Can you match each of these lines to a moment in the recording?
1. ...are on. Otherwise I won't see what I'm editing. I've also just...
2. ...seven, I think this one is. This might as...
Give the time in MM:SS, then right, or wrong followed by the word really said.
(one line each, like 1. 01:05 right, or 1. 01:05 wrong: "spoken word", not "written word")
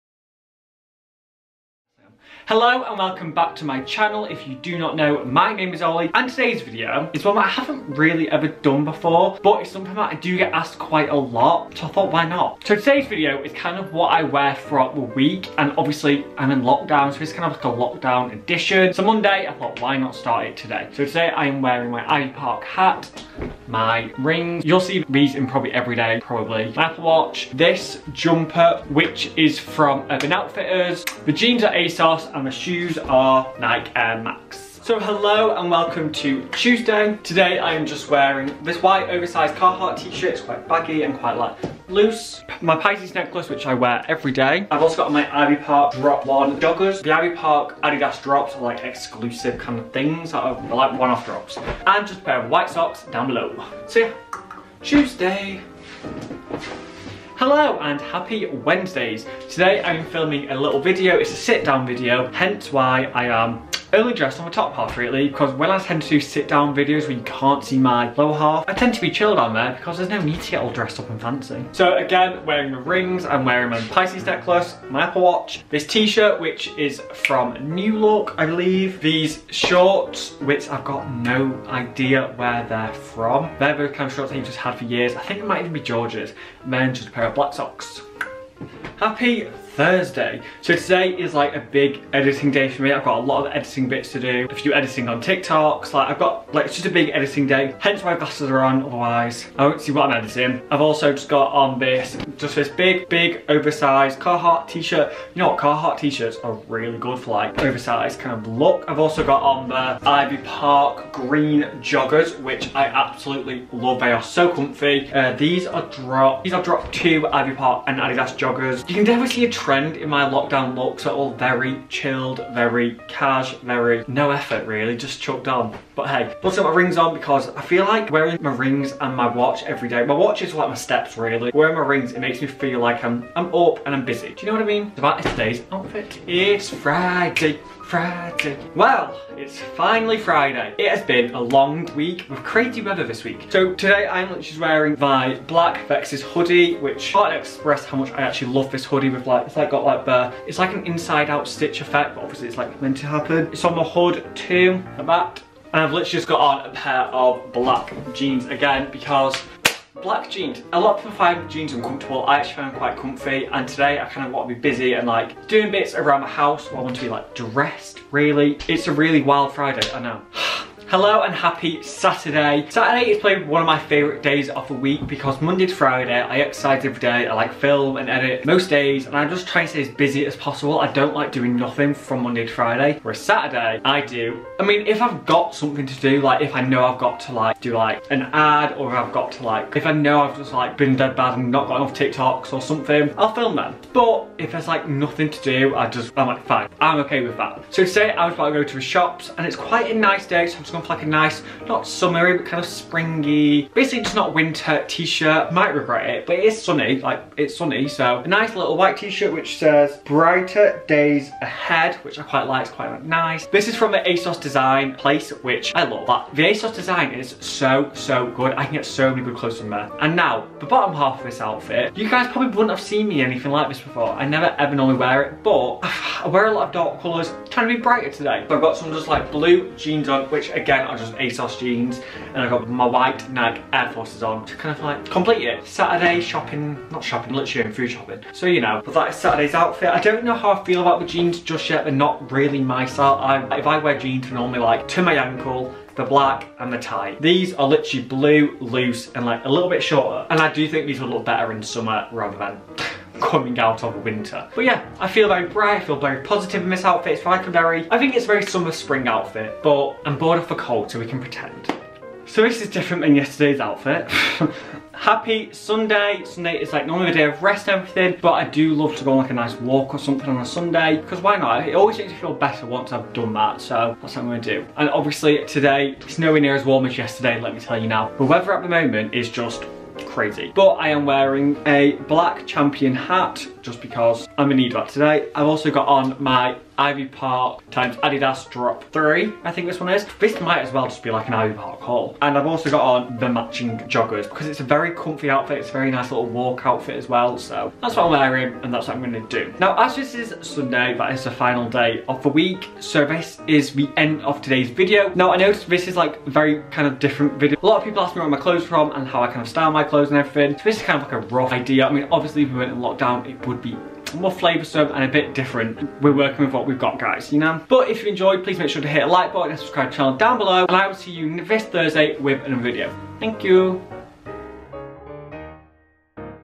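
1. 01:38 right
2. 04:48 wrong: "three", not "seven".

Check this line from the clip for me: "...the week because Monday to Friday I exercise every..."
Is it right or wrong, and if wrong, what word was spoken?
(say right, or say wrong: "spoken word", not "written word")
right.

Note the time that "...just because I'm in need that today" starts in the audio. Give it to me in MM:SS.
04:43.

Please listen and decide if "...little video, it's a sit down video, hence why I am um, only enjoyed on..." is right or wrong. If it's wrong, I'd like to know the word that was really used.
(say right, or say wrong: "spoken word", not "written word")
wrong: "dressed", not "enjoyed".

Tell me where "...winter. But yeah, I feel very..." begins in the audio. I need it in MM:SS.
04:14.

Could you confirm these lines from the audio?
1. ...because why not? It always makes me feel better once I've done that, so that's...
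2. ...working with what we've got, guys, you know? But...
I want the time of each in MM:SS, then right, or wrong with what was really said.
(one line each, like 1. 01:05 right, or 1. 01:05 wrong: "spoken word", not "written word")
1. 04:30 right
2. 05:16 right.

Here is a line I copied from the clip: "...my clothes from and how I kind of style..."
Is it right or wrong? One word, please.
right.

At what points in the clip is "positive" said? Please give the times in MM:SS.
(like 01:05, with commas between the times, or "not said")
04:16.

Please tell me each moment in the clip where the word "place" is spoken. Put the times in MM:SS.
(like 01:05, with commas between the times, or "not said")
03:34.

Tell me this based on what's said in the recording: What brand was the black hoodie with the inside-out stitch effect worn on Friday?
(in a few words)
Vex's.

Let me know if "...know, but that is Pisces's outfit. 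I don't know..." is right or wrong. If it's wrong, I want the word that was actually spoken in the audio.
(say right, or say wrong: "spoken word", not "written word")
wrong: "Saturday", not "Pisces".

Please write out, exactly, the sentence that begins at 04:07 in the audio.
These are literally blue, loose and like a little bit shorter.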